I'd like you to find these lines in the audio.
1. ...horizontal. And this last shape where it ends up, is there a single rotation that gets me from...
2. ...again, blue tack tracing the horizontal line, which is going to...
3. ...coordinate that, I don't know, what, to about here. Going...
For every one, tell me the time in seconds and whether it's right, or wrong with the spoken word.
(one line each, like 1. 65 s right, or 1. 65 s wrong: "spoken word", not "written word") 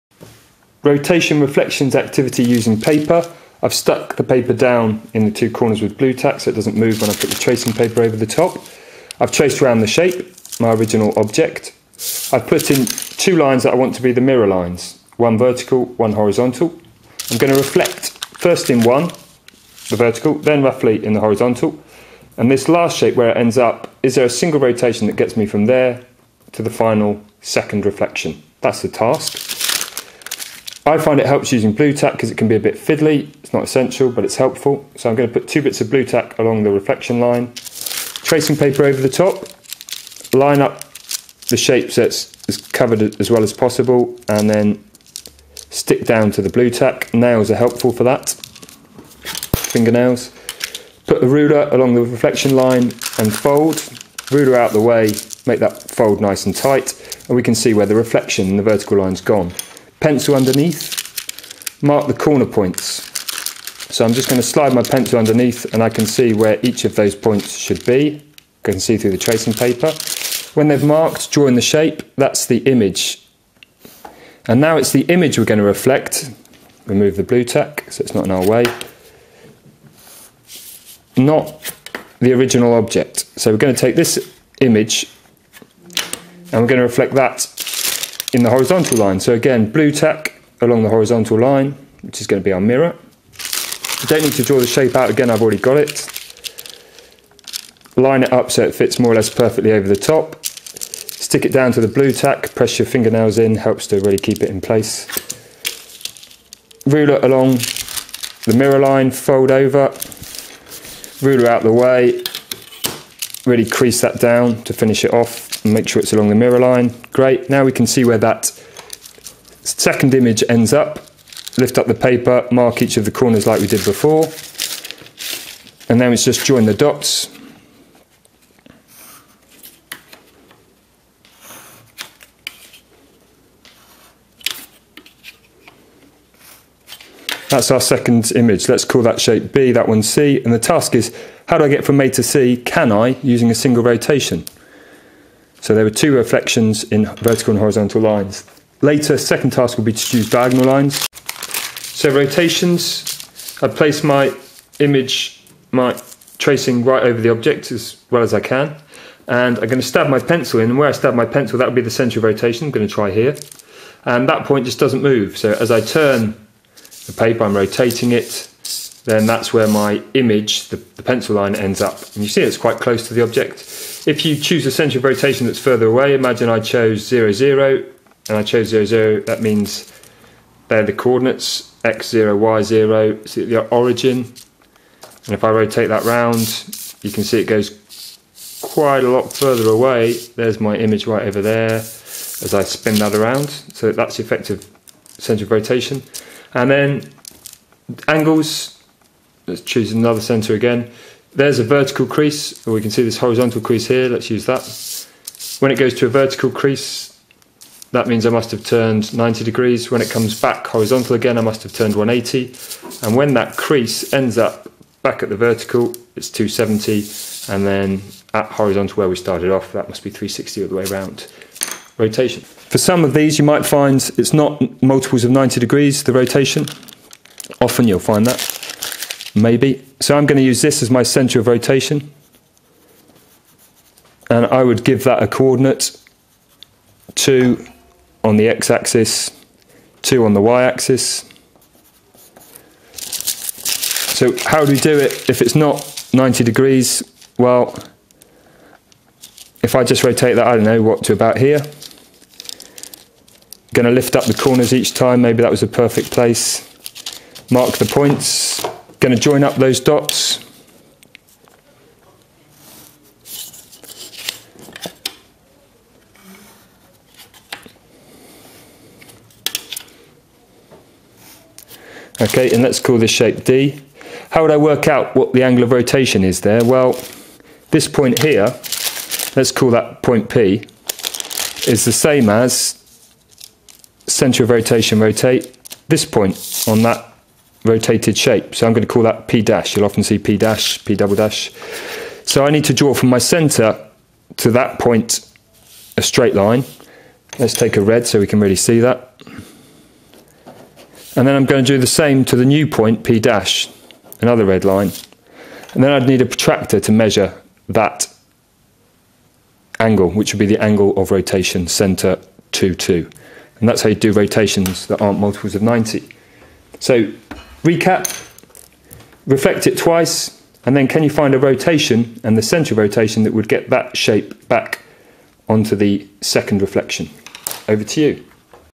1. 21 s right
2. 89 s wrong: "along", not "tracing"
3. 250 s wrong: "rotate", not "coordinate".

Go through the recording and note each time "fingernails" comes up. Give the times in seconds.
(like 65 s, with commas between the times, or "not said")
49 s, 102 s.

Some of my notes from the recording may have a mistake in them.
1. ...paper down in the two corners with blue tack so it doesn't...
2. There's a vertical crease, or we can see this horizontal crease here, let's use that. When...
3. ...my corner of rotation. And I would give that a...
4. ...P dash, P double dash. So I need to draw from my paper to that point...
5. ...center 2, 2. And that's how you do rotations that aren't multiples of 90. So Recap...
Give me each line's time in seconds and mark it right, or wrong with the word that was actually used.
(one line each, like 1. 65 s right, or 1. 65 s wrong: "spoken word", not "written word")
1. 4 s right
2. 201 s right
3. 230 s wrong: "center", not "corner"
4. 290 s wrong: "center", not "paper"
5. 311 s right.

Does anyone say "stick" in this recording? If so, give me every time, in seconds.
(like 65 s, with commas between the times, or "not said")
45 s, 100 s.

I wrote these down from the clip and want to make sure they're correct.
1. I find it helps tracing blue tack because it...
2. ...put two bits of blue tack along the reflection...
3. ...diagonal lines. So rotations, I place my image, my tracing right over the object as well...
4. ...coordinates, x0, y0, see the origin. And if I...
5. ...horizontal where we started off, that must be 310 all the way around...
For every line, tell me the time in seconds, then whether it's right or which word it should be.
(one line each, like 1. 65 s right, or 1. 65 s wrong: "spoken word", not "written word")
1. 30 s wrong: "using", not "tracing"
2. 35 s right
3. 150 s right
4. 180 s right
5. 218 s wrong: "360", not "310".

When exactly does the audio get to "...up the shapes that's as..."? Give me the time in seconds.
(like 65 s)
40 s.